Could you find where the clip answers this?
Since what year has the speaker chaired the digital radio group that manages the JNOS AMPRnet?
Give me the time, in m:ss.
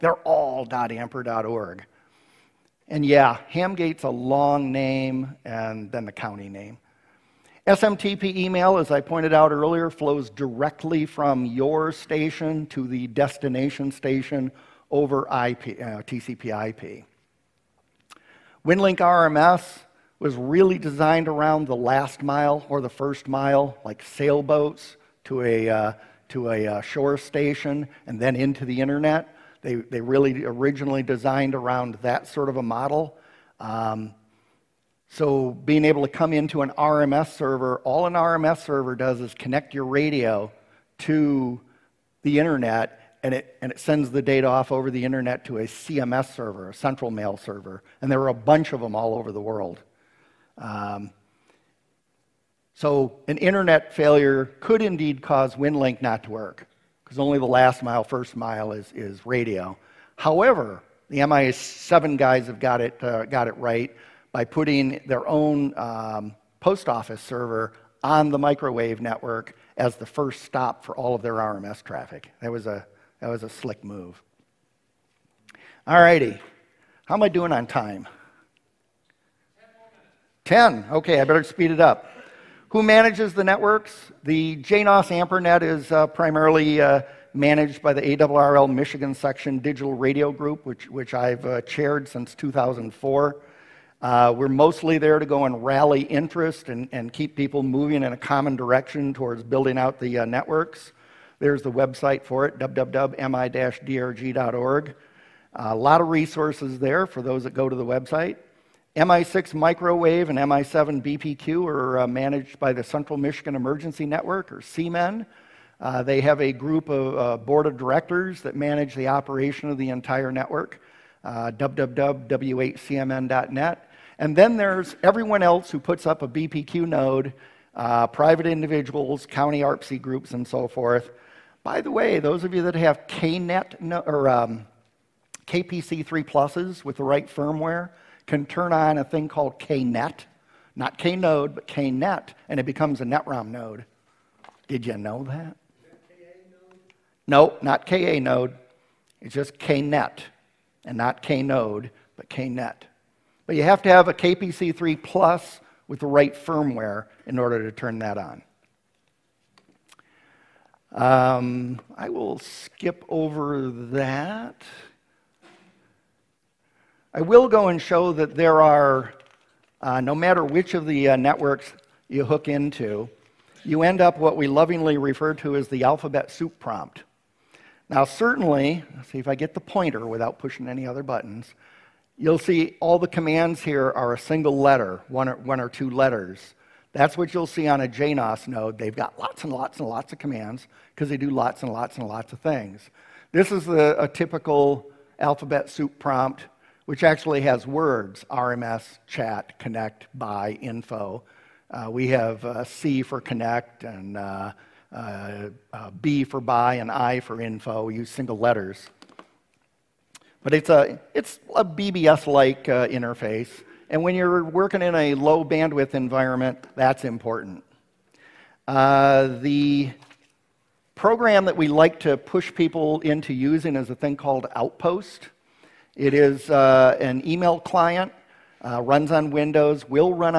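1:32.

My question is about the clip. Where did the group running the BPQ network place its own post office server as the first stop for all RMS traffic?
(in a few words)
microwave network.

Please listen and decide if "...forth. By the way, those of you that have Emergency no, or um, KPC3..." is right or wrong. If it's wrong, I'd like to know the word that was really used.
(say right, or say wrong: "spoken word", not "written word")
wrong: "KNet", not "Emergency".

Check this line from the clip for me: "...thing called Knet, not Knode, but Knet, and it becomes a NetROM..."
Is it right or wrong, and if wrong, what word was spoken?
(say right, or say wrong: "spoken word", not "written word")
right.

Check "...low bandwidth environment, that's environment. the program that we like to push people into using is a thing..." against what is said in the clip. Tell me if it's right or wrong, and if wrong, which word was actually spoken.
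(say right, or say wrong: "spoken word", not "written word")
wrong: "important", not "environment".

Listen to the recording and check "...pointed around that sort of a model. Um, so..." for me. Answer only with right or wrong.
wrong.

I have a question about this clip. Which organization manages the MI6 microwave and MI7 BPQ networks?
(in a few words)
Central Michigan Emergency Network.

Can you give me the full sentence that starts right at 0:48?
And there were a bunch of them all over the world.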